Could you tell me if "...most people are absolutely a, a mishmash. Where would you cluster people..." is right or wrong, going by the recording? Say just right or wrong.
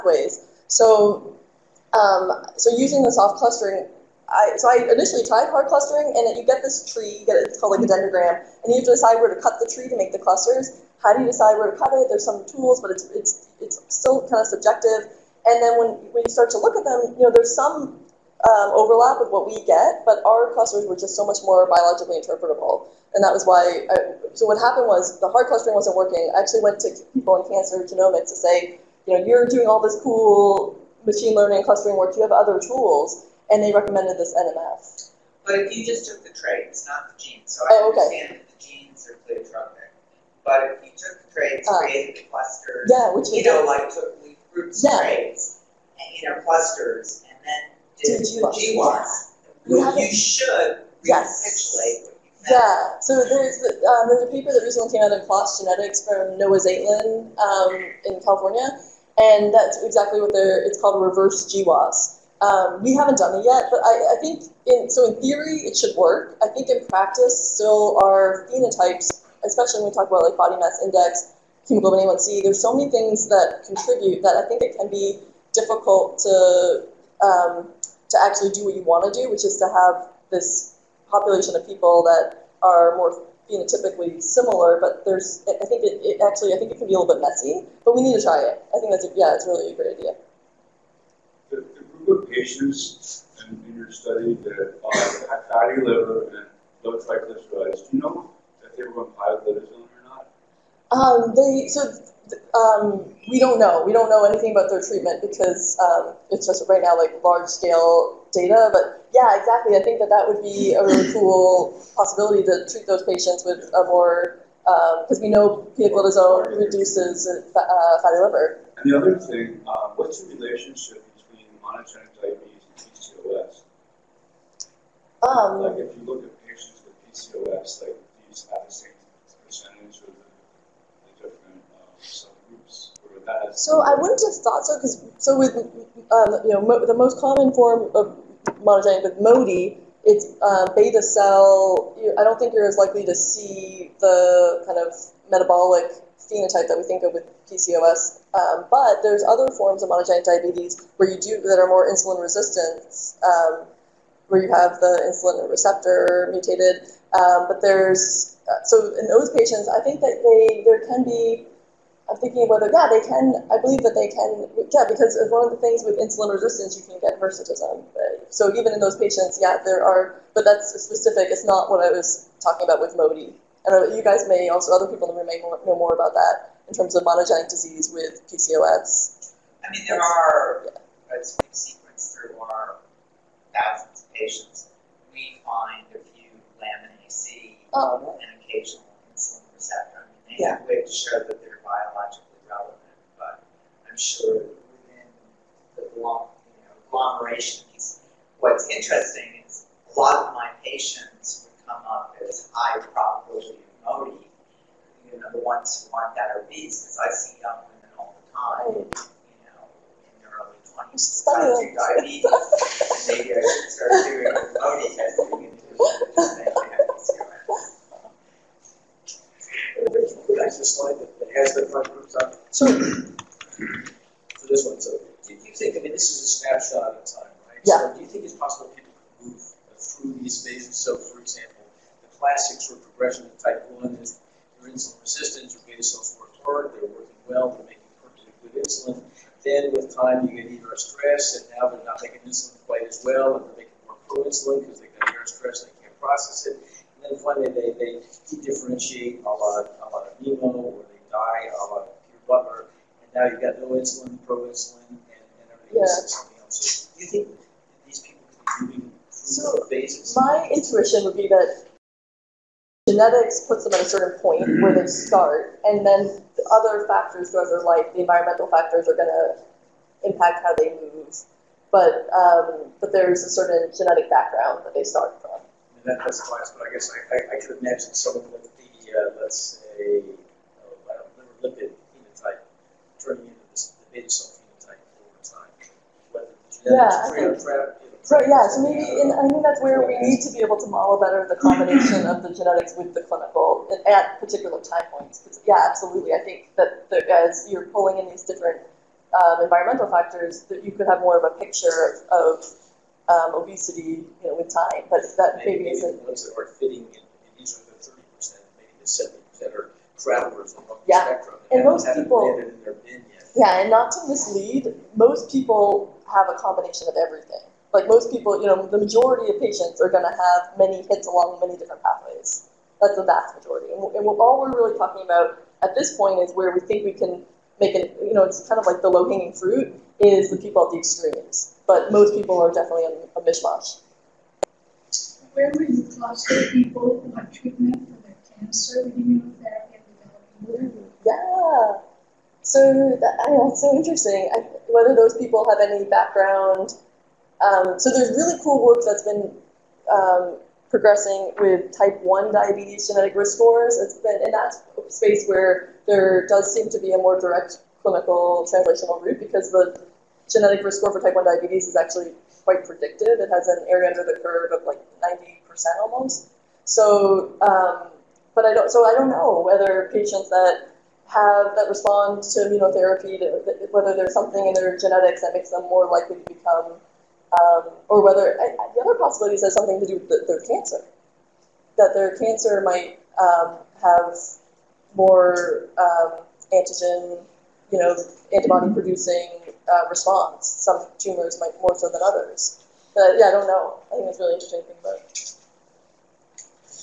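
wrong.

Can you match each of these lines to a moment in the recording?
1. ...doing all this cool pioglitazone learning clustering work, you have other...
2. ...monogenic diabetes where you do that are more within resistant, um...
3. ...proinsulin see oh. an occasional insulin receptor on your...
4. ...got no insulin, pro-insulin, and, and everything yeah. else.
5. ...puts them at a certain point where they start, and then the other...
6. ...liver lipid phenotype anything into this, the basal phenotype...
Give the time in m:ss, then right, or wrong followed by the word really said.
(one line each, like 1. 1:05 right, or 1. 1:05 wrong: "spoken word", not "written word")
1. 0:29 wrong: "machine", not "pioglitazone"
2. 2:29 wrong: "insulin", not "within"
3. 3:06 wrong: "lamin", not "proinsulin"
4. 4:13 right
5. 4:23 right
6. 4:41 wrong: "turning", not "anything".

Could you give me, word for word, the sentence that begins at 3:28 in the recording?
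you know, in their early 20s, Diabetes, and maybe I should start doing MODY testing.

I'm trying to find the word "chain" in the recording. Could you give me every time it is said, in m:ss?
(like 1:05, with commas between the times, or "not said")
not said.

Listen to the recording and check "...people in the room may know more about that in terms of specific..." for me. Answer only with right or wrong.
wrong.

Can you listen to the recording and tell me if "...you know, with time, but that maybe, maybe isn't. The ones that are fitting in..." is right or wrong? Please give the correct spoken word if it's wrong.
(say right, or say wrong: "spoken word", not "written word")
right.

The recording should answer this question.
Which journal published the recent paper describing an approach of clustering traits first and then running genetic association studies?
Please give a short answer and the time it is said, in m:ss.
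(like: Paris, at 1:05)
PLOS Genetics, at 0:55.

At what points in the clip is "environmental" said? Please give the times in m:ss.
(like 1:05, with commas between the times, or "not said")
4:28, 4:59.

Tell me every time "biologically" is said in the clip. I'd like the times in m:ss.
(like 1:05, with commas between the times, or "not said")
0:21, 3:11.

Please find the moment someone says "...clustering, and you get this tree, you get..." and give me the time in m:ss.
0:05.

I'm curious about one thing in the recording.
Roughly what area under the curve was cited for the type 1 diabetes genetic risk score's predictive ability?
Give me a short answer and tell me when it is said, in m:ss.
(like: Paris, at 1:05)
90%, at 6:05.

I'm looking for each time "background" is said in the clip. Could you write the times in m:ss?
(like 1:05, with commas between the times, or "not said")
4:34, 5:45.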